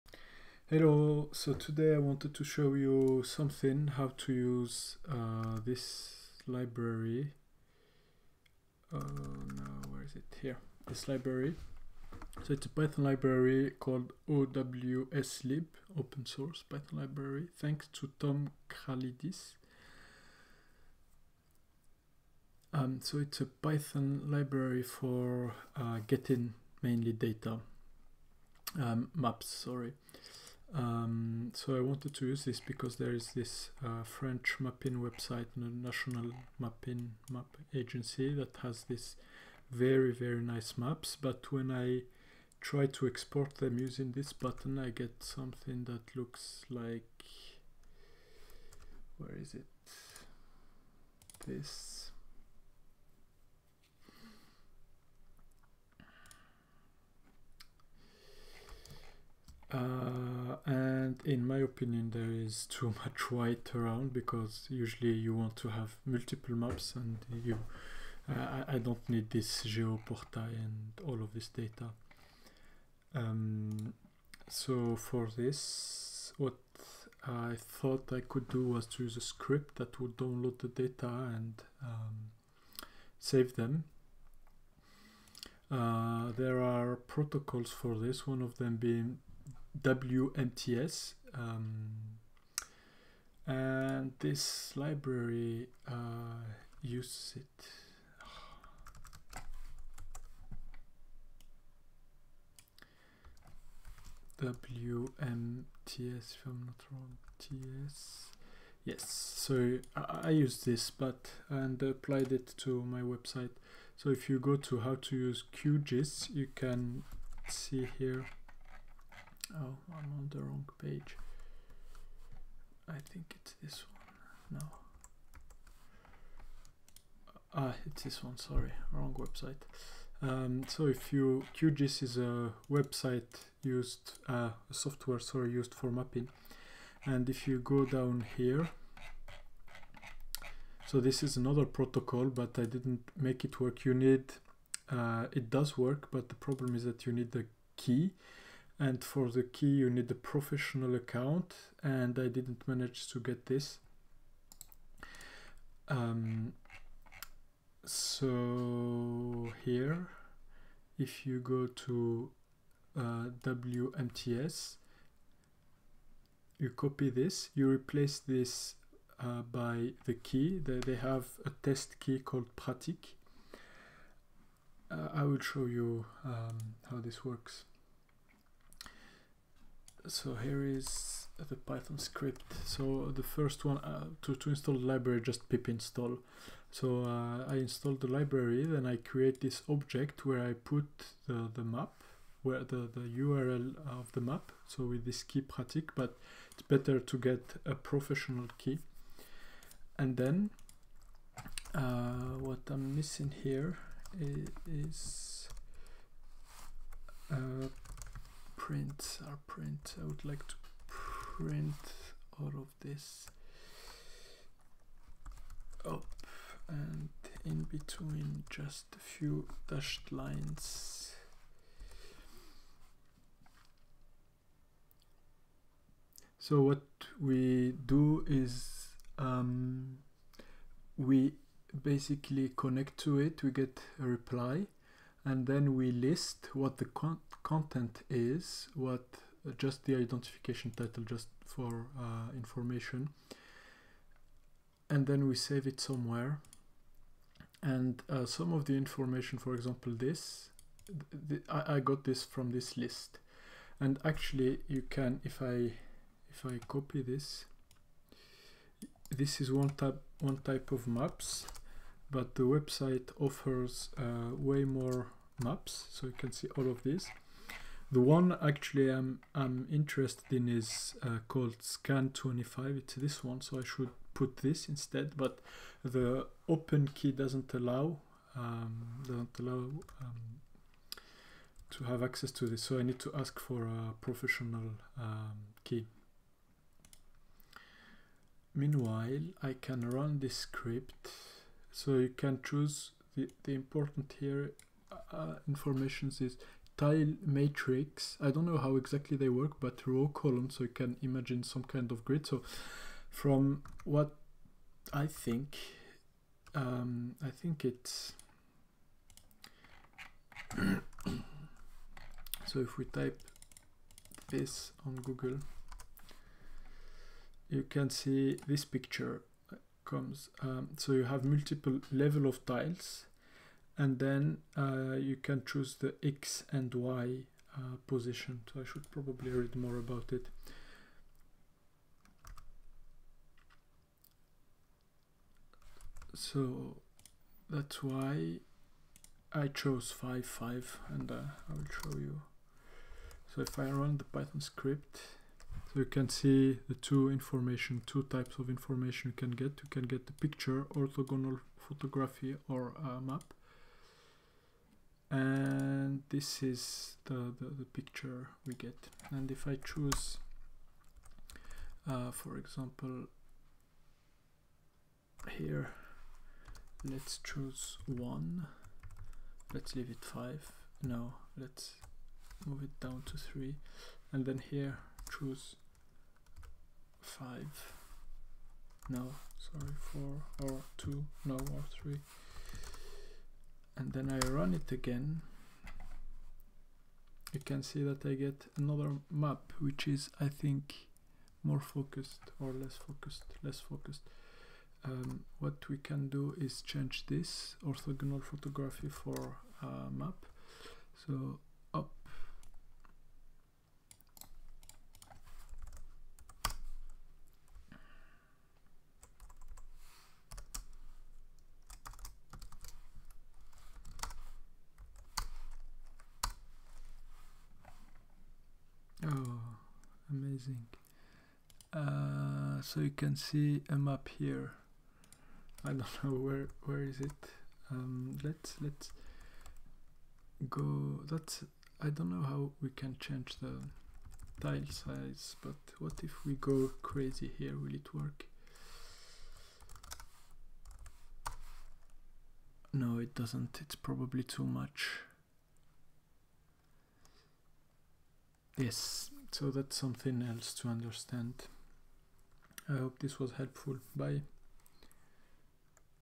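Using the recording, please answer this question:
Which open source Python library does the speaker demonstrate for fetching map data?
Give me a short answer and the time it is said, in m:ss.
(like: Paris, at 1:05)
OWSLib, at 0:14.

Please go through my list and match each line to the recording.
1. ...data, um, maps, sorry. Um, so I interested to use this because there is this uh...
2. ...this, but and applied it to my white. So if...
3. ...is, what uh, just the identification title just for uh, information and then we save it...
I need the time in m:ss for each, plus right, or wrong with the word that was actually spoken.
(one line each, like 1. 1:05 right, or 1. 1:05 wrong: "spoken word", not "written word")
1. 0:27 wrong: "wanted", not "interested"
2. 1:50 wrong: "website", not "white"
3. 3:58 right.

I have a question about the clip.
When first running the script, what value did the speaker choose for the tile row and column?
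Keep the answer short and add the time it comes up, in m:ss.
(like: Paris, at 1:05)
5, at 5:39.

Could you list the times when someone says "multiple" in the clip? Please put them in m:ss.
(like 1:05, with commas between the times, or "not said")
1:06, 5:21.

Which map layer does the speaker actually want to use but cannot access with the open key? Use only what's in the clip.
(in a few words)
scan25.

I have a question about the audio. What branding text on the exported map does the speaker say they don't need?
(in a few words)
Geoportail.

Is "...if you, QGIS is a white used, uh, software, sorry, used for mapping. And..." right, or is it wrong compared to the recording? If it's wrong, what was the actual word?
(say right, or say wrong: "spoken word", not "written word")
wrong: "website", not "white".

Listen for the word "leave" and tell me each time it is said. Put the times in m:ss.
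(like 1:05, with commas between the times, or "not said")
6:09.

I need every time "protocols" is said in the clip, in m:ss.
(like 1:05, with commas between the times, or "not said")
1:26, 2:21.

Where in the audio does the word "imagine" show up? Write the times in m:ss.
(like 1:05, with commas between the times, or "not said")
5:01.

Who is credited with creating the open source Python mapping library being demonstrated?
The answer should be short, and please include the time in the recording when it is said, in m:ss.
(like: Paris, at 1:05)
Tom Kralidis, at 0:18.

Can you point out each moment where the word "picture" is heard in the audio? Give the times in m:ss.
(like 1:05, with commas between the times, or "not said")
5:18, 5:50, 5:57.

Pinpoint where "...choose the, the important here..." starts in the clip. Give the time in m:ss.
4:52.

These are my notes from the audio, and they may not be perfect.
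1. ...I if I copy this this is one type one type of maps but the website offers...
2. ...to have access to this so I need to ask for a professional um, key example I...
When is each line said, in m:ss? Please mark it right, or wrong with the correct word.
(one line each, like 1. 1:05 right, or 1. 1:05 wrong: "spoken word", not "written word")
1. 4:15 right
2. 4:41 wrong: "meanwhile", not "example".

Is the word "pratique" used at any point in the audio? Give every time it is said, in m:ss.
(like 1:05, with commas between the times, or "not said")
2:52, 3:15.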